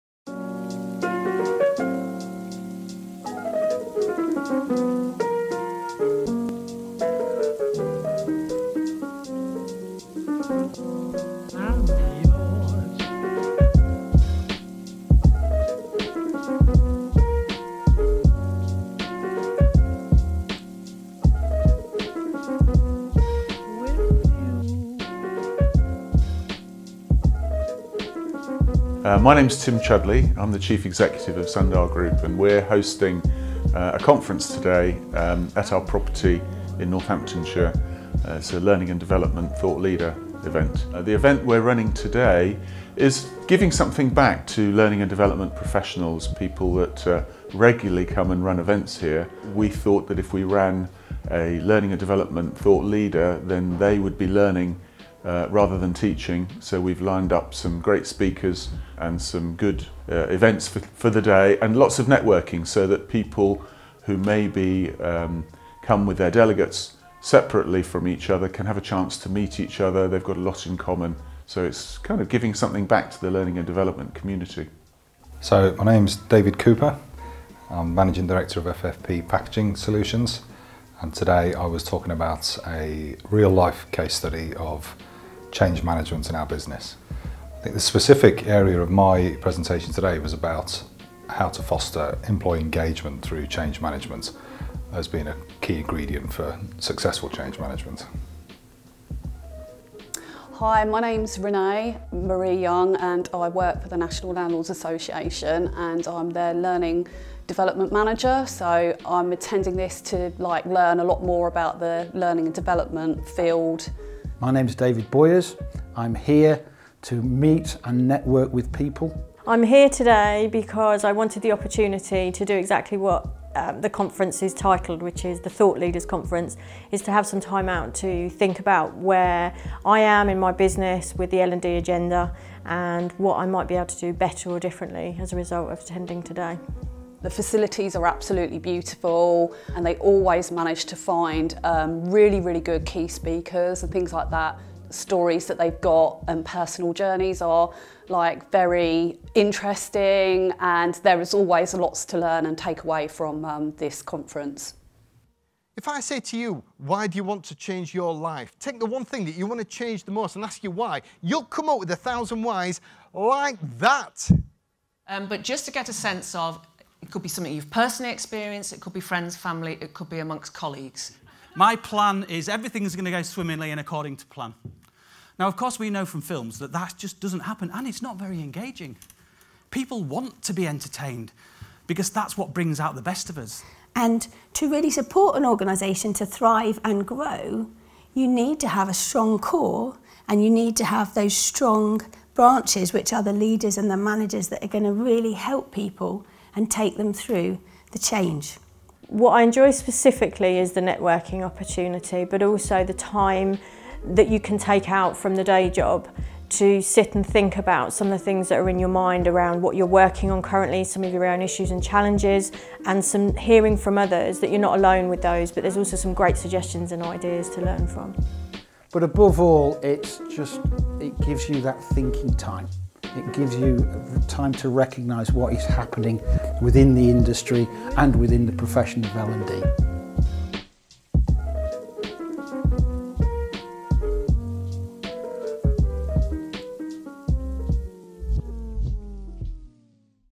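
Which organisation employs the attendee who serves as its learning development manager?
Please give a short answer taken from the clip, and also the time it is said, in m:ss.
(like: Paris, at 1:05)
National Landlords Association, at 1:43.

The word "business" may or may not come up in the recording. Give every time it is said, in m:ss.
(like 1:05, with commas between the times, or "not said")
1:26, 2:10.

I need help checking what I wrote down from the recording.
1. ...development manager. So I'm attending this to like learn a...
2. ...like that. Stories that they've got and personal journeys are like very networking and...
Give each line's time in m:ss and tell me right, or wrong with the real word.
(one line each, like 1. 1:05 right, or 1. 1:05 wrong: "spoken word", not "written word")
1. 1:47 right
2. 2:24 wrong: "interesting", not "networking".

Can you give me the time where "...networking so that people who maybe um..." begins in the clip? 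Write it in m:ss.
1:02.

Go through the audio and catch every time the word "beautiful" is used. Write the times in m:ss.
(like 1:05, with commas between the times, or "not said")
2:18.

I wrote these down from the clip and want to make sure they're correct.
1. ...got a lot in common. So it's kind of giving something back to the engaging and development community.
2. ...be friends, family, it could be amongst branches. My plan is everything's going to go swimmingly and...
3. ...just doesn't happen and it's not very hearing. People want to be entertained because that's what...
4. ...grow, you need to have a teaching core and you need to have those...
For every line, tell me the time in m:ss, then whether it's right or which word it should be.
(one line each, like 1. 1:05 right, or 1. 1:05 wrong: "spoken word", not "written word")
1. 1:10 wrong: "learning", not "engaging"
2. 2:48 wrong: "colleagues", not "branches"
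3. 2:56 wrong: "engaging", not "hearing"
4. 3:07 wrong: "strong", not "teaching".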